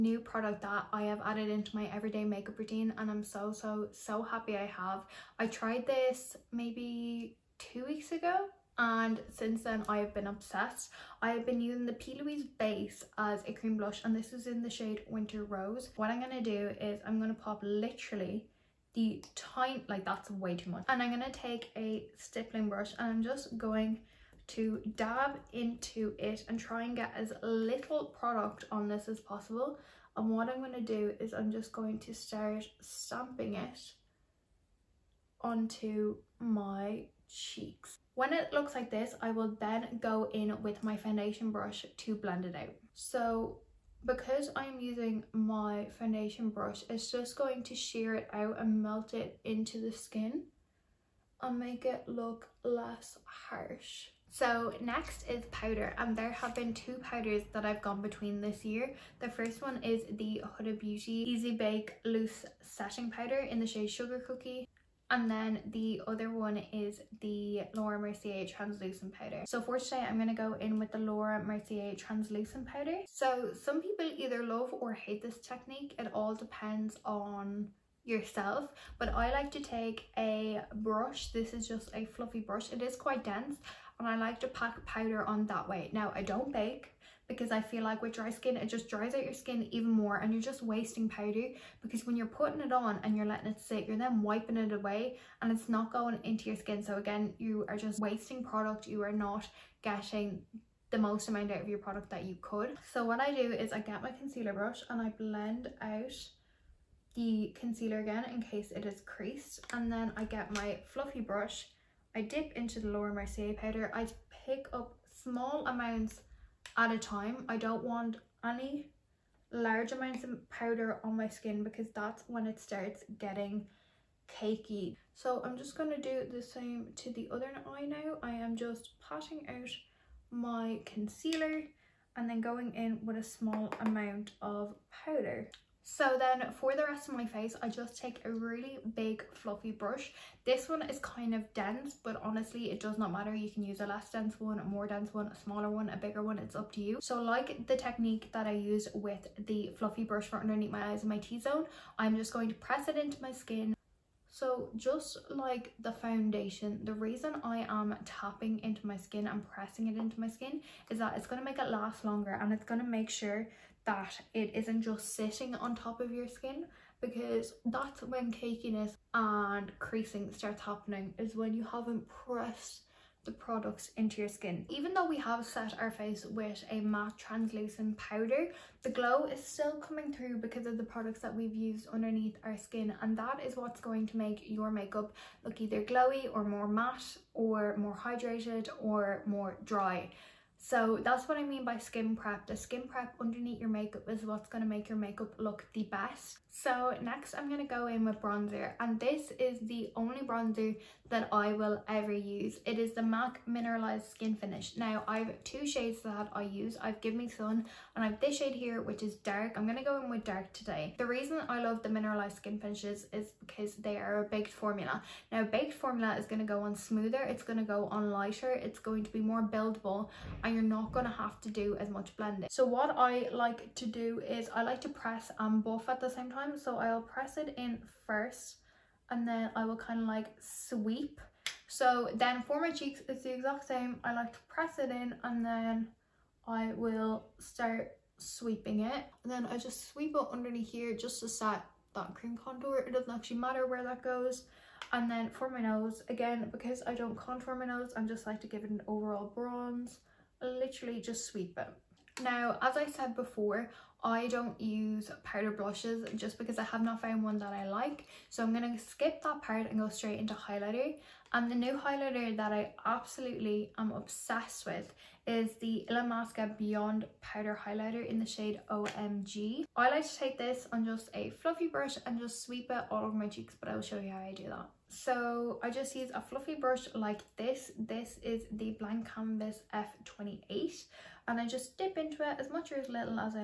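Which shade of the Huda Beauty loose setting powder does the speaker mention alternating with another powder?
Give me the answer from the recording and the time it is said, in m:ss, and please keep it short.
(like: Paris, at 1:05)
Sugar Cookie, at 1:03.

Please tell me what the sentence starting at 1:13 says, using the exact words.
So some people either love or hate this technique.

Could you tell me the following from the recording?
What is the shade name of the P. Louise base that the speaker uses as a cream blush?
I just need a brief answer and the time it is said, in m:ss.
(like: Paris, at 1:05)
Winter Rose, at 0:15.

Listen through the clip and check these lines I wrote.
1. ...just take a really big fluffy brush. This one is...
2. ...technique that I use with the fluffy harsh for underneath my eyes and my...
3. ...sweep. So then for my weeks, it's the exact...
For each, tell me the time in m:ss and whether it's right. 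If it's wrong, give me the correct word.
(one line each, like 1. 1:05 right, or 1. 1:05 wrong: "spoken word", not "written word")
1. 2:17 right
2. 2:27 wrong: "brush", not "harsh"
3. 3:50 wrong: "cheeks", not "weeks".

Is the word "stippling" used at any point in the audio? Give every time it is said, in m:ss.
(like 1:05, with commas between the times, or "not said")
0:22.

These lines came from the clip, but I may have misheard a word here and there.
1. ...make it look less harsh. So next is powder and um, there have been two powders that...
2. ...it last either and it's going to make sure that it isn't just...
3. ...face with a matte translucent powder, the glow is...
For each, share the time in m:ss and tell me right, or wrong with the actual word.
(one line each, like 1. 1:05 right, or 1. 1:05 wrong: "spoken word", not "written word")
1. 0:51 right
2. 2:41 wrong: "longer", not "either"
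3. 2:55 right.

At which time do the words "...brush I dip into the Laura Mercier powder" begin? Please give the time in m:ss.
1:51.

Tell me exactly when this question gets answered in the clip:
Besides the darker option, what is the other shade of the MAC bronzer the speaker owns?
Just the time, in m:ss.
3:27.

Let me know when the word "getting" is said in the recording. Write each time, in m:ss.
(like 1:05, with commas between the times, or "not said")
1:39, 2:03.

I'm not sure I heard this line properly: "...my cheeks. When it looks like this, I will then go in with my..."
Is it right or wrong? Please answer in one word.
right.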